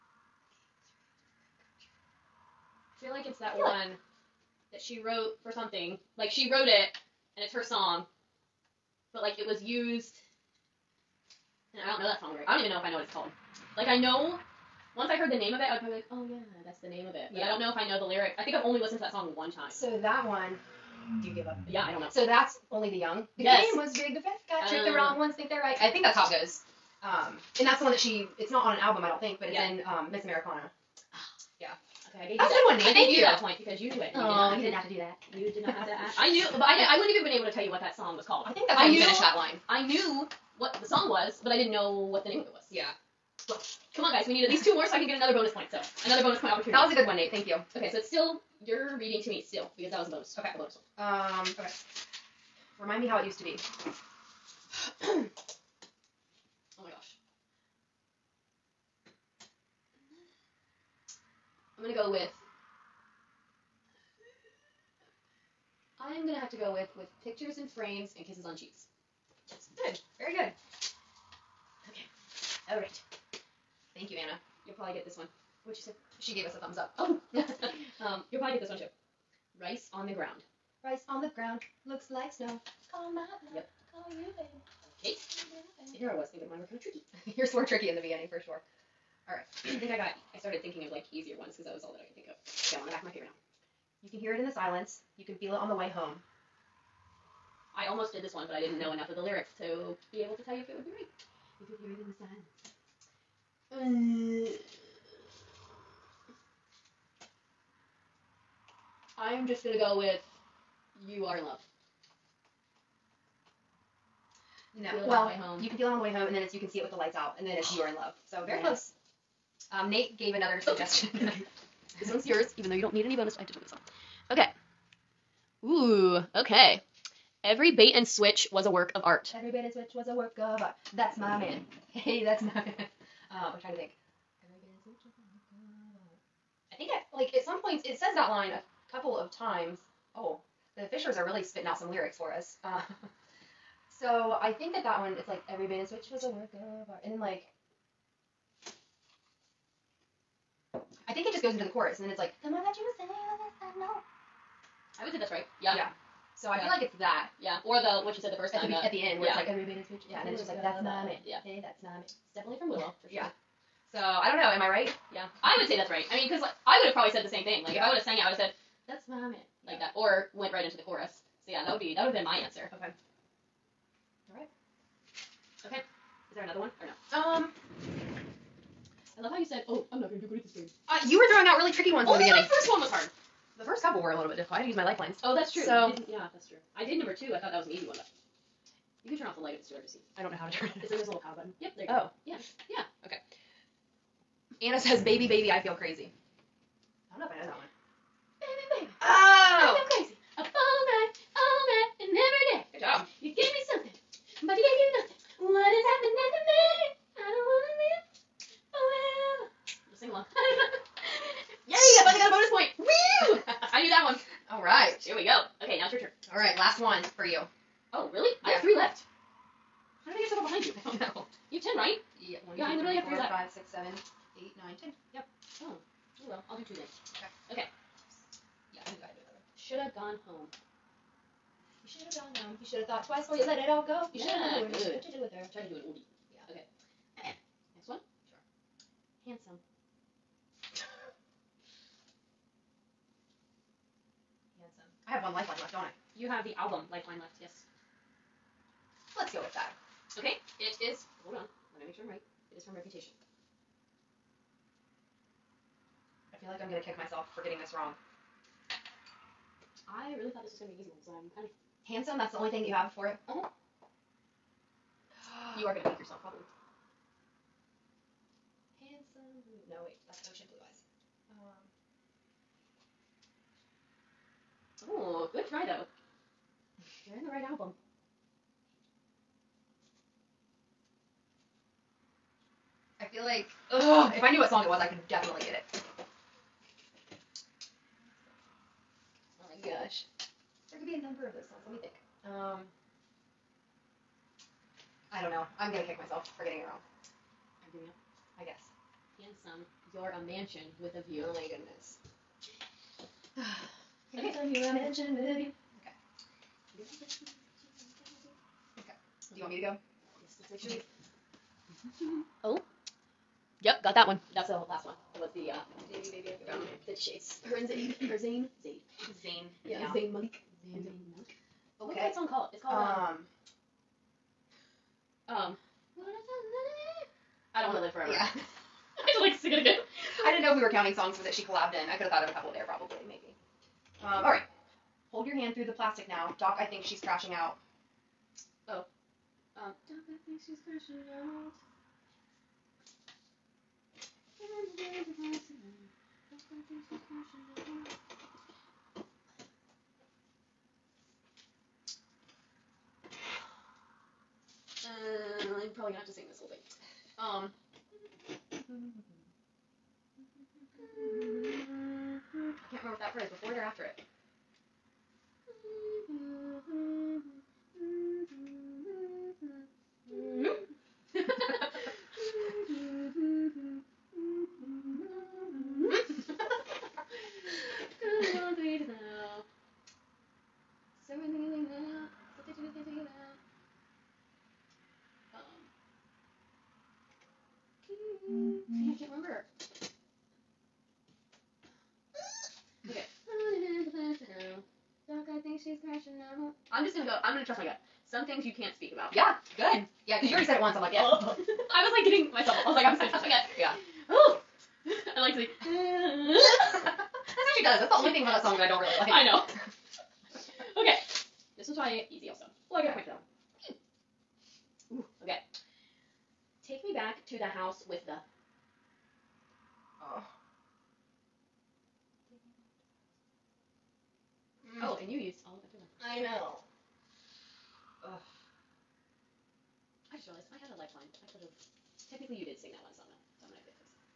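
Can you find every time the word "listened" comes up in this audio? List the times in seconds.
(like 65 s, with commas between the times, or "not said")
18 s.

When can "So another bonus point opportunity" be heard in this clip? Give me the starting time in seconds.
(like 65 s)
45 s.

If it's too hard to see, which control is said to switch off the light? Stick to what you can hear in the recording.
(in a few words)
power button.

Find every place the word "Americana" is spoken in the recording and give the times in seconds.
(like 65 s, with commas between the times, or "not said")
30 s.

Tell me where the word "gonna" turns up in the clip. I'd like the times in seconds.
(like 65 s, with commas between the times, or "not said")
61 s, 66 s, 109 s, 180 s, 295 s, 403 s.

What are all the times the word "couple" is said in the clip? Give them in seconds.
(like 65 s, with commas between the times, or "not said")
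138 s, 183 s, 332 s.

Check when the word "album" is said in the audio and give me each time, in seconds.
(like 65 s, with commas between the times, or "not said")
28 s, 277 s.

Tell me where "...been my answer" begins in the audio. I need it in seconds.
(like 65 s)
172 s.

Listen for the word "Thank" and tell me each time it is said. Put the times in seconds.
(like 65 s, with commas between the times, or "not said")
32 s, 47 s, 73 s.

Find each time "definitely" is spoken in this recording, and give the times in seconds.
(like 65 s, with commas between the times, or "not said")
162 s, 285 s.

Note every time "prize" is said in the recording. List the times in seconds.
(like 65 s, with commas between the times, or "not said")
not said.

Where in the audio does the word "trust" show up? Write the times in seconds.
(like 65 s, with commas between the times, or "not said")
397 s, 403 s.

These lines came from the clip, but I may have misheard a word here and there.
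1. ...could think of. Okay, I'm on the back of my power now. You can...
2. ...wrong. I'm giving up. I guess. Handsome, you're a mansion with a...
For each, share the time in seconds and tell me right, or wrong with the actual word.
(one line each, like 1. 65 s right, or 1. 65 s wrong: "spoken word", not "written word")
1. 92 s wrong: "paper", not "power"
2. 296 s right.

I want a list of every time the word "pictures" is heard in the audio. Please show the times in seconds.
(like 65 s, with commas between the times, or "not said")
67 s.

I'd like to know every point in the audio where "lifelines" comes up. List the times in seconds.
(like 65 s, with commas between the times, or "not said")
184 s, 430 s.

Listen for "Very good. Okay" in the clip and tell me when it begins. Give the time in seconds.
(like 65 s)
70 s.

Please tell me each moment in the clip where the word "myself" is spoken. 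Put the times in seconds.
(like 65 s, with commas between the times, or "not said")
256 s, 296 s, 402 s.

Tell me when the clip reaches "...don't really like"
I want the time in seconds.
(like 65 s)
408 s.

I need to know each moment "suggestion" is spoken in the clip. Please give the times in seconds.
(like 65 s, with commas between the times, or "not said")
120 s.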